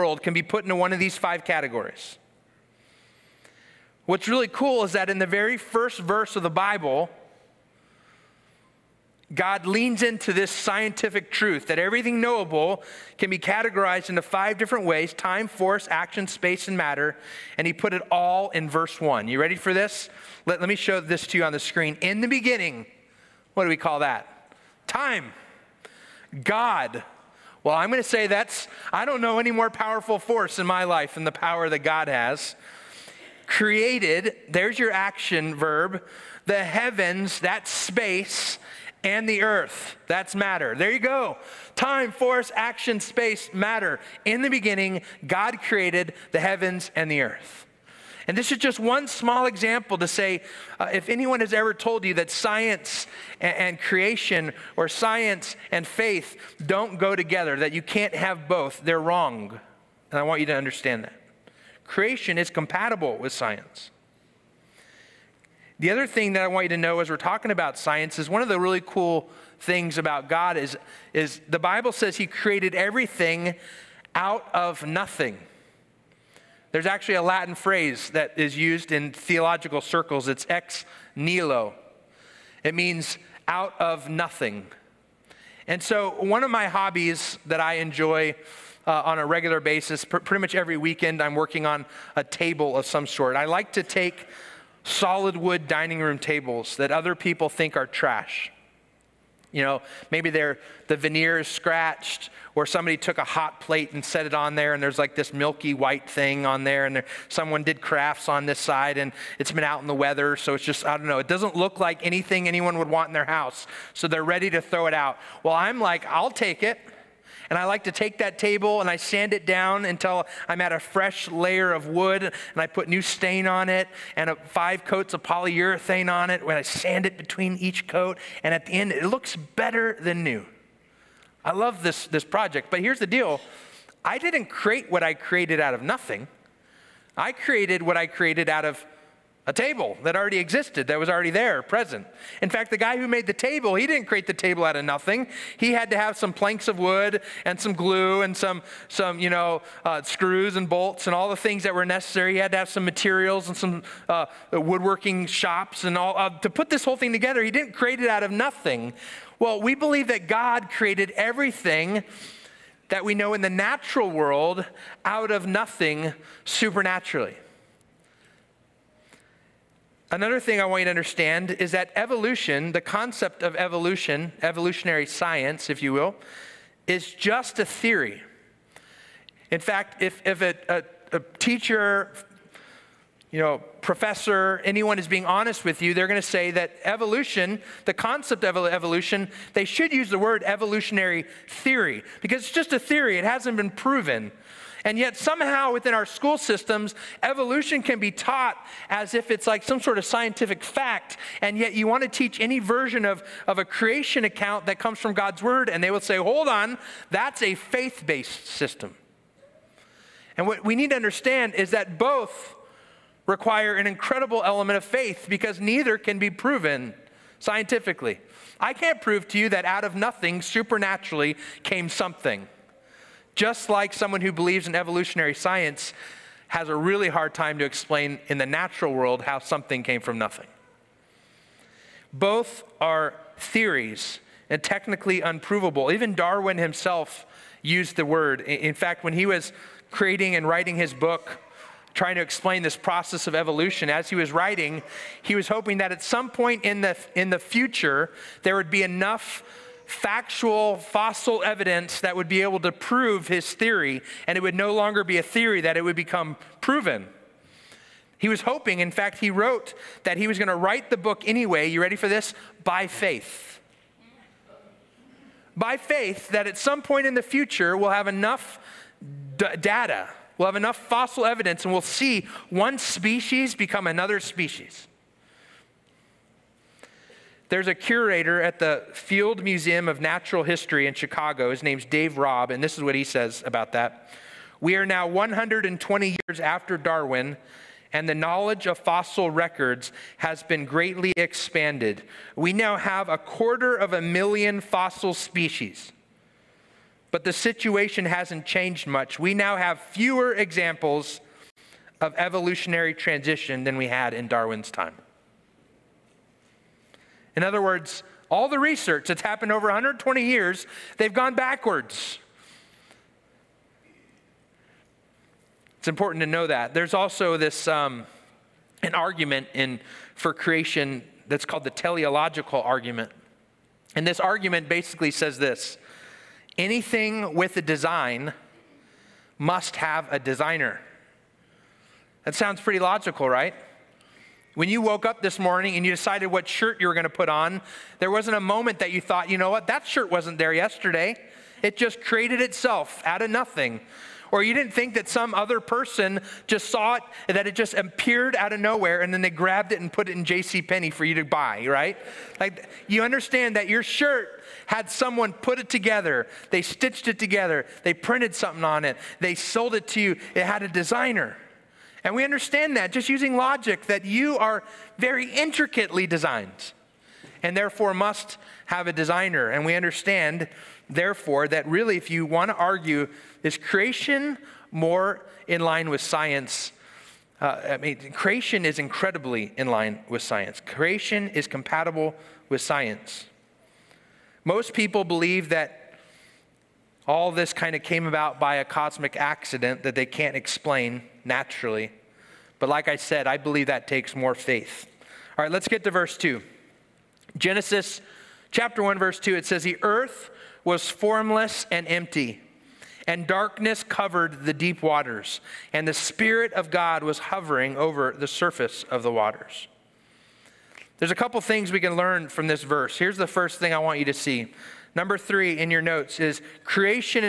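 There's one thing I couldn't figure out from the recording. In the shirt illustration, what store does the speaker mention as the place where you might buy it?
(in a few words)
J.C. Penney.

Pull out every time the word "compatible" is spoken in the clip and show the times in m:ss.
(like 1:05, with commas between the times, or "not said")
1:02, 6:21.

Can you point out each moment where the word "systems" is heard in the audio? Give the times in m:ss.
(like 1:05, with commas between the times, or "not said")
3:16, 3:28.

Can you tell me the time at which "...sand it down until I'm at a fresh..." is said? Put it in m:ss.
1:58.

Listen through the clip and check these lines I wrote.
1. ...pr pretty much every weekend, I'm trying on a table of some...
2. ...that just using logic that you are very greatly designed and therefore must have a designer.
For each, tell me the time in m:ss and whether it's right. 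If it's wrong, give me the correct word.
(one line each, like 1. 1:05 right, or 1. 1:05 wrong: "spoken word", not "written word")
1. 1:30 wrong: "working", not "trying"
2. 6:02 wrong: "intricately", not "greatly".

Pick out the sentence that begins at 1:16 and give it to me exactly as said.
There's actually a Latin phrase that is used in theological circles.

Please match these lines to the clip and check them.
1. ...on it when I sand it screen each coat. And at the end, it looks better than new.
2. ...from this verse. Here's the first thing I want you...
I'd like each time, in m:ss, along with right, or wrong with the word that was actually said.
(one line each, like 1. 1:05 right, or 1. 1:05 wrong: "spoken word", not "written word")
1. 2:06 wrong: "between", not "screen"
2. 6:52 right.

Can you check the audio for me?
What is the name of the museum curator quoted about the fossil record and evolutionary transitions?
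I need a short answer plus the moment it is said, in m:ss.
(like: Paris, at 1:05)
Dave Raup, at 4:41.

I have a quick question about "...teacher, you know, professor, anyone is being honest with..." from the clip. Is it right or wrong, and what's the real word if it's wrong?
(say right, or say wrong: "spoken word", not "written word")
right.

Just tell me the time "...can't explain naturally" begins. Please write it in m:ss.
6:30.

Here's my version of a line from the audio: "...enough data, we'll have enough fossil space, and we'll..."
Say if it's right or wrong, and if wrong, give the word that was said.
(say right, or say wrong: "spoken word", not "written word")
wrong: "evidence", not "space".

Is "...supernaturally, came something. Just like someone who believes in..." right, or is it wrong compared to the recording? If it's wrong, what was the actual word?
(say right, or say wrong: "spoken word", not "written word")
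right.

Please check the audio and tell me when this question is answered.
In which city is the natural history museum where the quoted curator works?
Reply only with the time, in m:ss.
4:40.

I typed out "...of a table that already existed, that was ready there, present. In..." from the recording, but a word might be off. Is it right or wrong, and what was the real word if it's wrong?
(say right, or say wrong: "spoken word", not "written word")
wrong: "already", not "ready".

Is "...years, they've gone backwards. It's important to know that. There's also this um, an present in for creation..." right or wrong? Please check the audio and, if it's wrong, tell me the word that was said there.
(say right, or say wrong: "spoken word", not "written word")
wrong: "argument", not "present".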